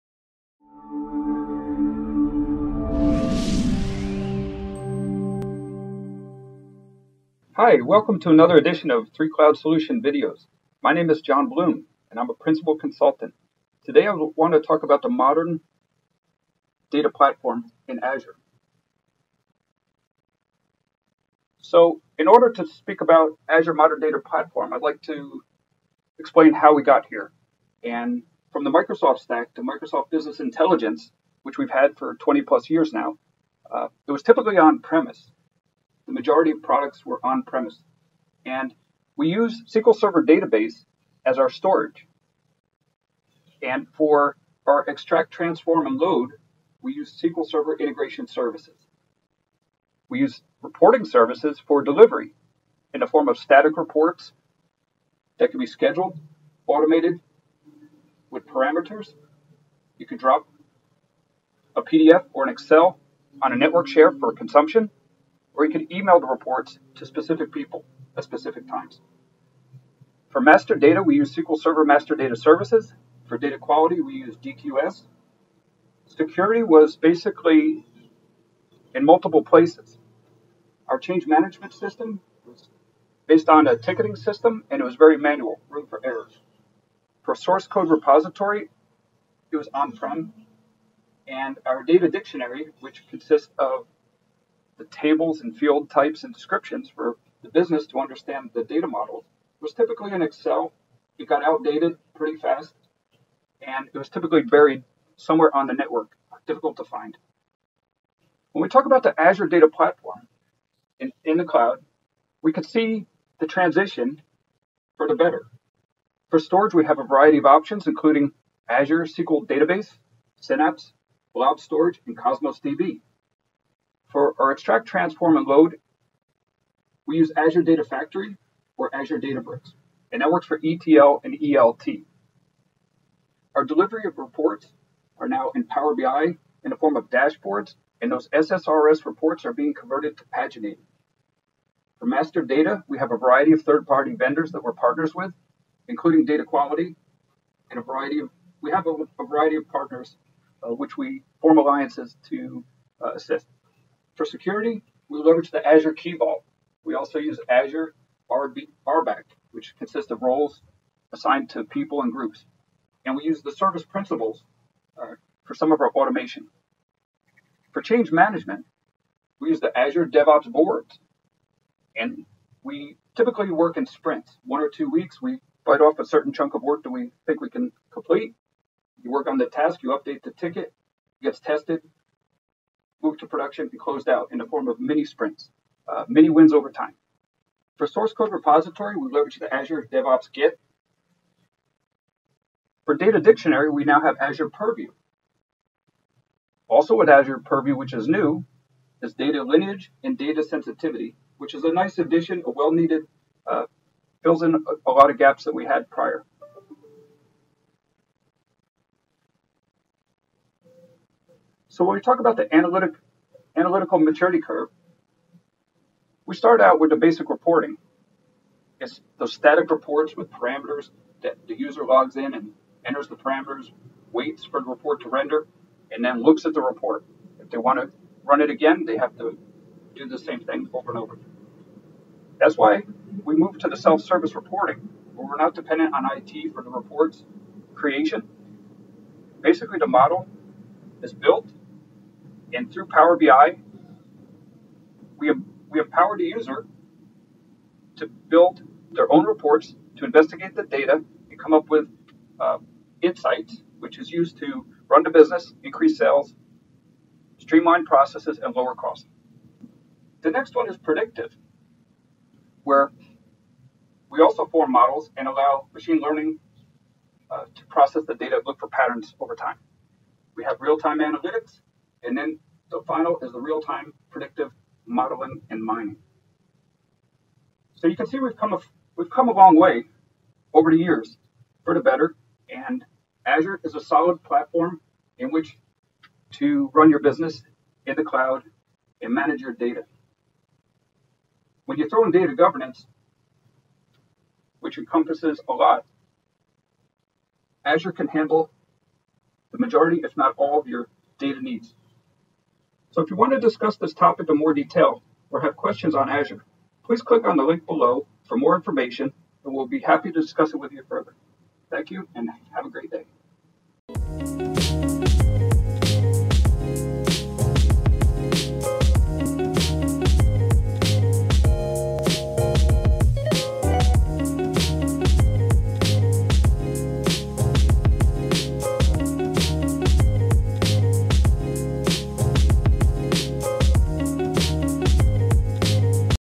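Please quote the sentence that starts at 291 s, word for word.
When you throw in data governance, which encompasses a lot, Azure can handle the majority, if not all, of your data needs.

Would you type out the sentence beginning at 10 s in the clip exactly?
My name is John Bloom, and I'm a principal consultant.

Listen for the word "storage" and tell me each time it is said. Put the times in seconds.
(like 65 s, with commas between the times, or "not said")
41 s, 116 s, 121 s.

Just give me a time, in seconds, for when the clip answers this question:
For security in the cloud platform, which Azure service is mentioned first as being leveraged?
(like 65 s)
155 s.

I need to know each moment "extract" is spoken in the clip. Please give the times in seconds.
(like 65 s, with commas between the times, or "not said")
44 s, 124 s.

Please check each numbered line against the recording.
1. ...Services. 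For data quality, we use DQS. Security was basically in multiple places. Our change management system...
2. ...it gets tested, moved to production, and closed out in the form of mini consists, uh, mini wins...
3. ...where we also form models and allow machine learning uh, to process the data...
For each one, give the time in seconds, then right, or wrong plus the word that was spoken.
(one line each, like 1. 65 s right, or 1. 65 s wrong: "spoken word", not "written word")
1. 72 s right
2. 181 s wrong: "sprints", not "consists"
3. 262 s right.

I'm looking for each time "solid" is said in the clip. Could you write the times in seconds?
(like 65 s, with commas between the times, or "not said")
283 s.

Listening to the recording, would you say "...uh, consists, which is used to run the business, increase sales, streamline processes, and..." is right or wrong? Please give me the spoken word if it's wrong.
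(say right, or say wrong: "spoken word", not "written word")
wrong: "insights", not "consists".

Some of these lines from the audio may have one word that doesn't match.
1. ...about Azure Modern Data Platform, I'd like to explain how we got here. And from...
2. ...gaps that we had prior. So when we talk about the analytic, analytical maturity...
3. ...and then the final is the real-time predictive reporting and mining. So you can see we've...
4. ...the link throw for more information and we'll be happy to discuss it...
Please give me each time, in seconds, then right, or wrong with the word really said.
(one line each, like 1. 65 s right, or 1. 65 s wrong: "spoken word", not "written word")
1. 23 s right
2. 205 s right
3. 272 s wrong: "modeling", not "reporting"
4. 307 s wrong: "below", not "throw".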